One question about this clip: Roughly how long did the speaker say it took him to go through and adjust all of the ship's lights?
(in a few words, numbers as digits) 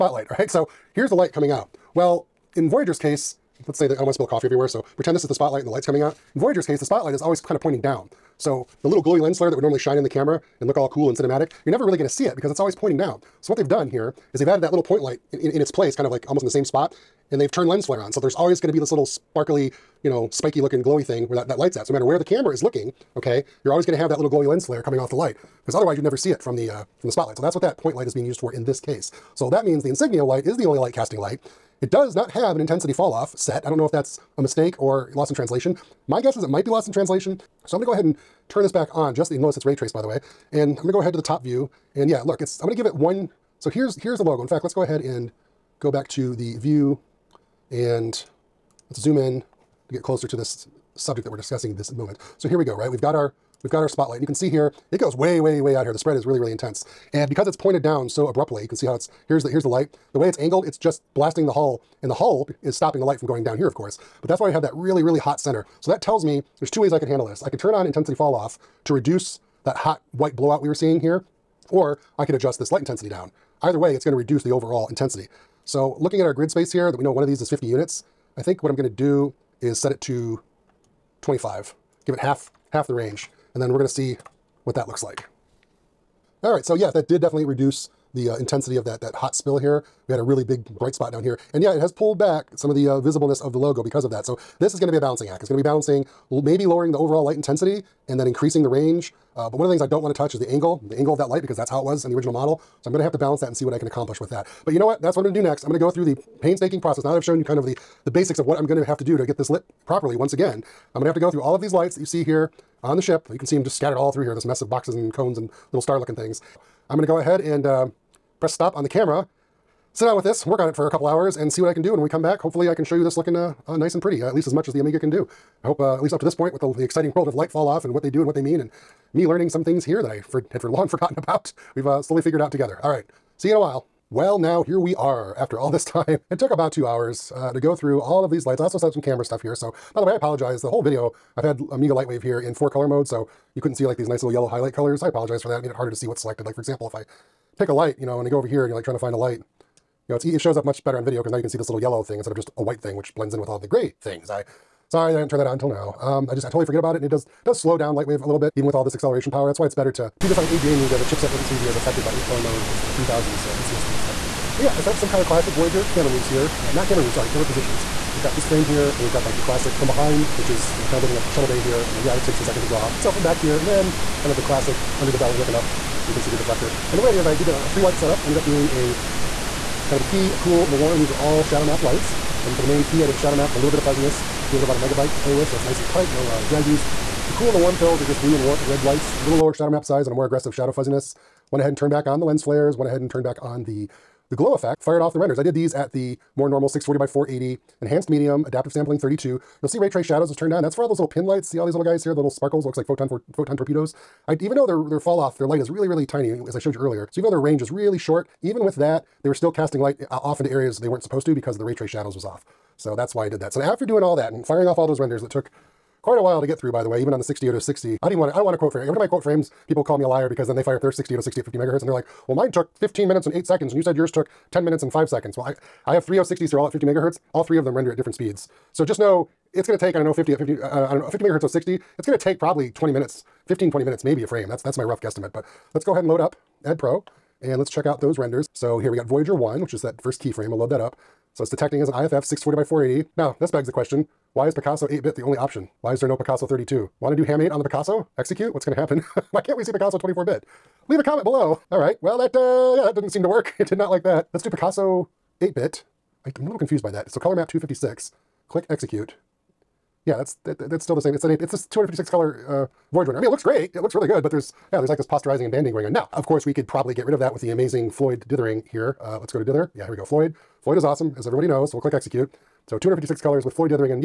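2 hours.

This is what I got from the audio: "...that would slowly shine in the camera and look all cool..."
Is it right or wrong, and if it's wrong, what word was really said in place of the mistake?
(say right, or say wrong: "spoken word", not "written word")
wrong: "normally", not "slowly".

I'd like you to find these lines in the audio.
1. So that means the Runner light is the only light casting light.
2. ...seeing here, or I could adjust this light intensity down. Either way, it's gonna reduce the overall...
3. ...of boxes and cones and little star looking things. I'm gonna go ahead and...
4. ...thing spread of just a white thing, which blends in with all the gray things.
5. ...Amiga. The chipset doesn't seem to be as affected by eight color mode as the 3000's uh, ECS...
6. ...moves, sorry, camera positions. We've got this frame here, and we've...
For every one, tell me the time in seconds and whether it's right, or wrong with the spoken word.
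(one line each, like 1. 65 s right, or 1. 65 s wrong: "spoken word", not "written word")
1. 29 s wrong: "Insignia", not "Runner"
2. 70 s right
3. 114 s right
4. 152 s wrong: "instead", not "spread"
5. 160 s right
6. 167 s right.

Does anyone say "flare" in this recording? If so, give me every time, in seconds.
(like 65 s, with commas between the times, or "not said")
9 s, 17 s, 24 s, 192 s.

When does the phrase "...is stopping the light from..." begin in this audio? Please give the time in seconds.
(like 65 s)
62 s.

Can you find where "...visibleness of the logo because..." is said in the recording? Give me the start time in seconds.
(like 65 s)
93 s.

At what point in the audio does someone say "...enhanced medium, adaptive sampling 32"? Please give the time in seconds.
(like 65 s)
197 s.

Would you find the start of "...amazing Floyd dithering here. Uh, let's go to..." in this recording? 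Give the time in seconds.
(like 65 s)
267 s.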